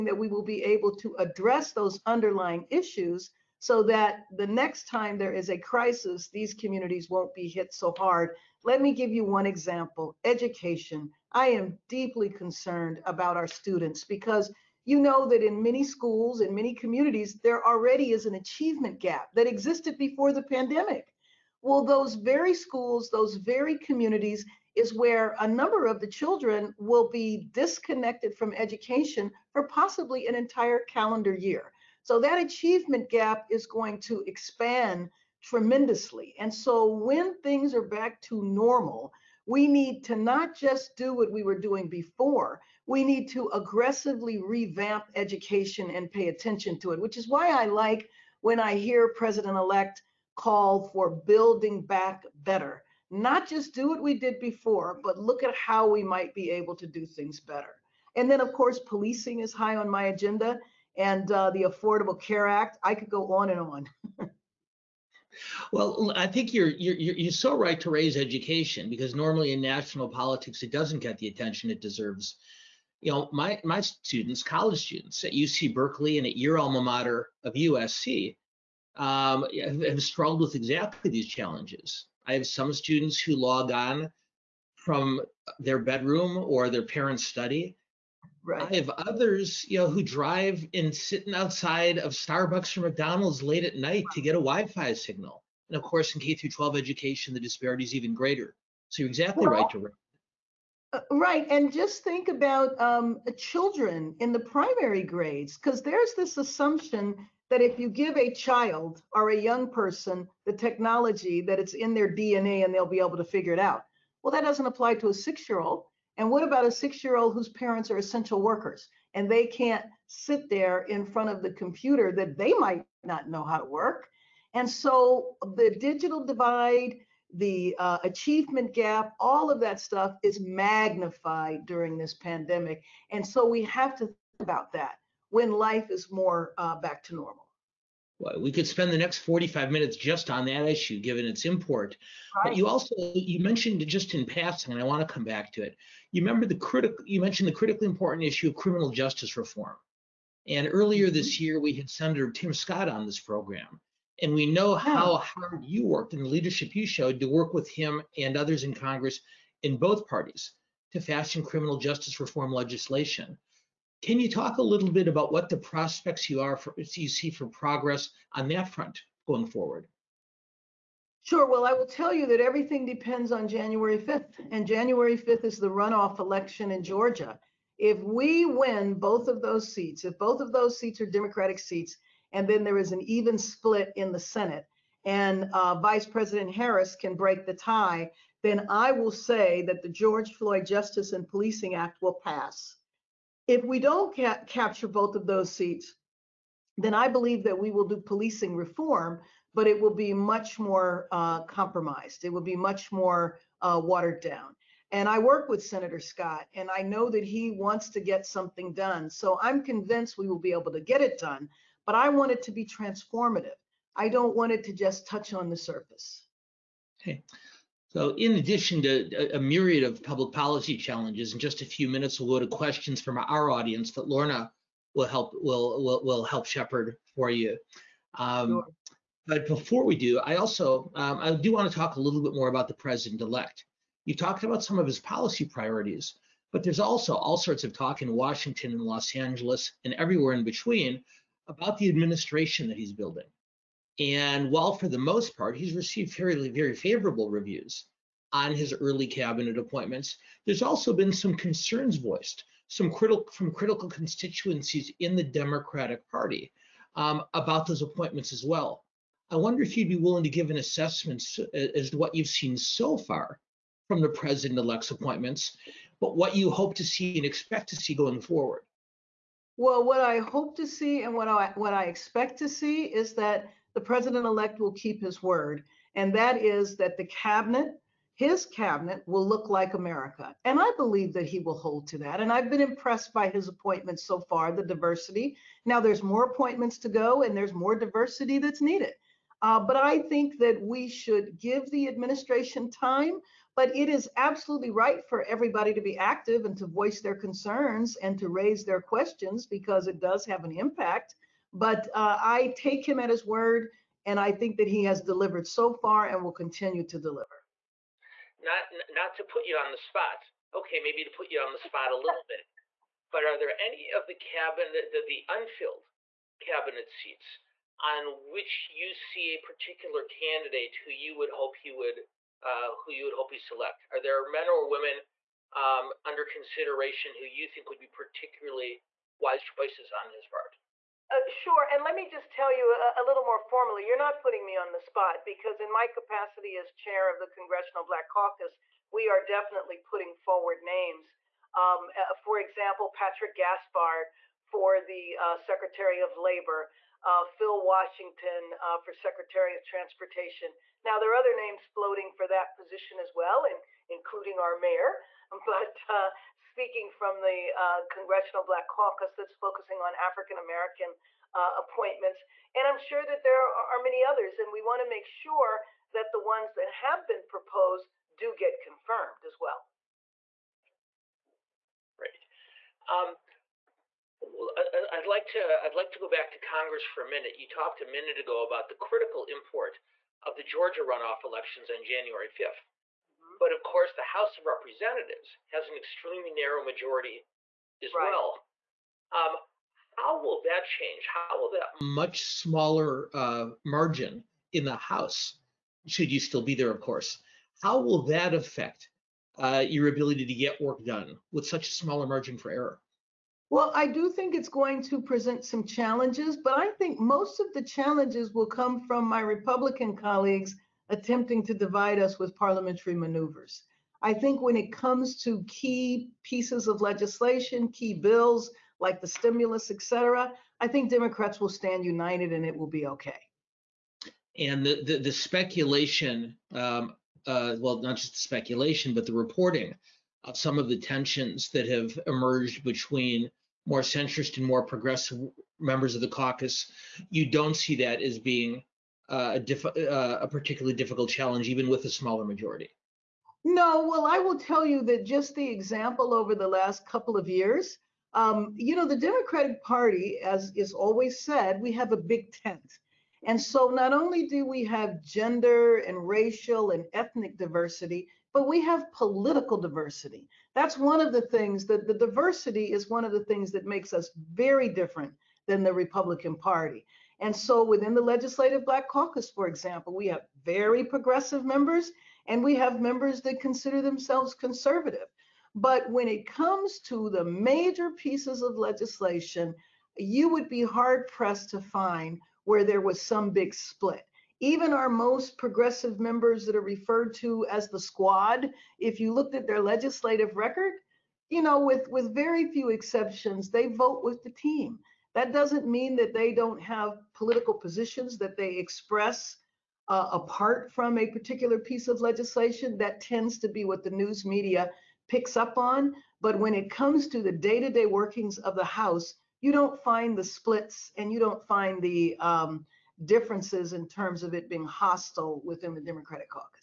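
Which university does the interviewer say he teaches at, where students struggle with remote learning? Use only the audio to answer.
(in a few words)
UC Berkeley.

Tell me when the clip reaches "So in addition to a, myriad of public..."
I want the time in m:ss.
3:37.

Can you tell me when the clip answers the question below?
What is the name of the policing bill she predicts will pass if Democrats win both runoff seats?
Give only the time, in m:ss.
3:09.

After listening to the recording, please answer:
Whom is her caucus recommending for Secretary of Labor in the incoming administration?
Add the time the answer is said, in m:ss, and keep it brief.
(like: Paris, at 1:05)
Patrick Gaspard, at 5:42.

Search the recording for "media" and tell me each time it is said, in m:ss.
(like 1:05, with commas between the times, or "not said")
8:24.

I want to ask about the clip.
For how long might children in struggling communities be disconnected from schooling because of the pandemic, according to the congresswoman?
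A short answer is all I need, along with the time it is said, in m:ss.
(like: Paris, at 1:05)
an entire calendar year, at 0:30.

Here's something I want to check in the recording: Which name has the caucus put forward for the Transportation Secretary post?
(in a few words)
Phil Washington.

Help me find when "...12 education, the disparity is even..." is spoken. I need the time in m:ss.
1:36.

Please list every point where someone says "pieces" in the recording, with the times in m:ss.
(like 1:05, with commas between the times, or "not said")
6:56, 7:57, 8:21.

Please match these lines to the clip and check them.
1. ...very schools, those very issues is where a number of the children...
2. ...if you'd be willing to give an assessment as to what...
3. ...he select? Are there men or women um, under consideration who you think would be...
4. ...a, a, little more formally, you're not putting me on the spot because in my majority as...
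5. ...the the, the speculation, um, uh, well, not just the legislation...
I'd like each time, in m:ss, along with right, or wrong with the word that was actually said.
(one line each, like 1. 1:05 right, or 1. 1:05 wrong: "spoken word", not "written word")
1. 0:22 wrong: "communities", not "issues"
2. 4:19 right
3. 5:23 right
4. 5:32 wrong: "capacity", not "majority"
5. 7:04 wrong: "speculation", not "legislation".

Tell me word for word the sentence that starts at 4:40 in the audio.
And I believe that he will hold to that.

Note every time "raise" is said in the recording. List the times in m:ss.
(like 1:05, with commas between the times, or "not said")
1:07, 4:58.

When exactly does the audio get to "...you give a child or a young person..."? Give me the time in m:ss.
1:47.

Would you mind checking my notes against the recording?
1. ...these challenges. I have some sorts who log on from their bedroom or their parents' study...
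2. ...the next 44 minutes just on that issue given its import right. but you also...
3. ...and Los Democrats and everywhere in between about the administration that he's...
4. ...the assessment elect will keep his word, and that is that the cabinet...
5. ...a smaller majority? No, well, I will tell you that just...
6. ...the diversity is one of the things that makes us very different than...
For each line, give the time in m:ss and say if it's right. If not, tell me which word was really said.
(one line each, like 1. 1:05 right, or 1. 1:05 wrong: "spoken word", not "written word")
1. 1:21 wrong: "students", not "sorts"
2. 2:18 wrong: "45", not "44"
3. 3:58 wrong: "Angeles", not "Democrats"
4. 4:33 wrong: "president", not "assessment"
5. 7:21 right
6. 7:41 right.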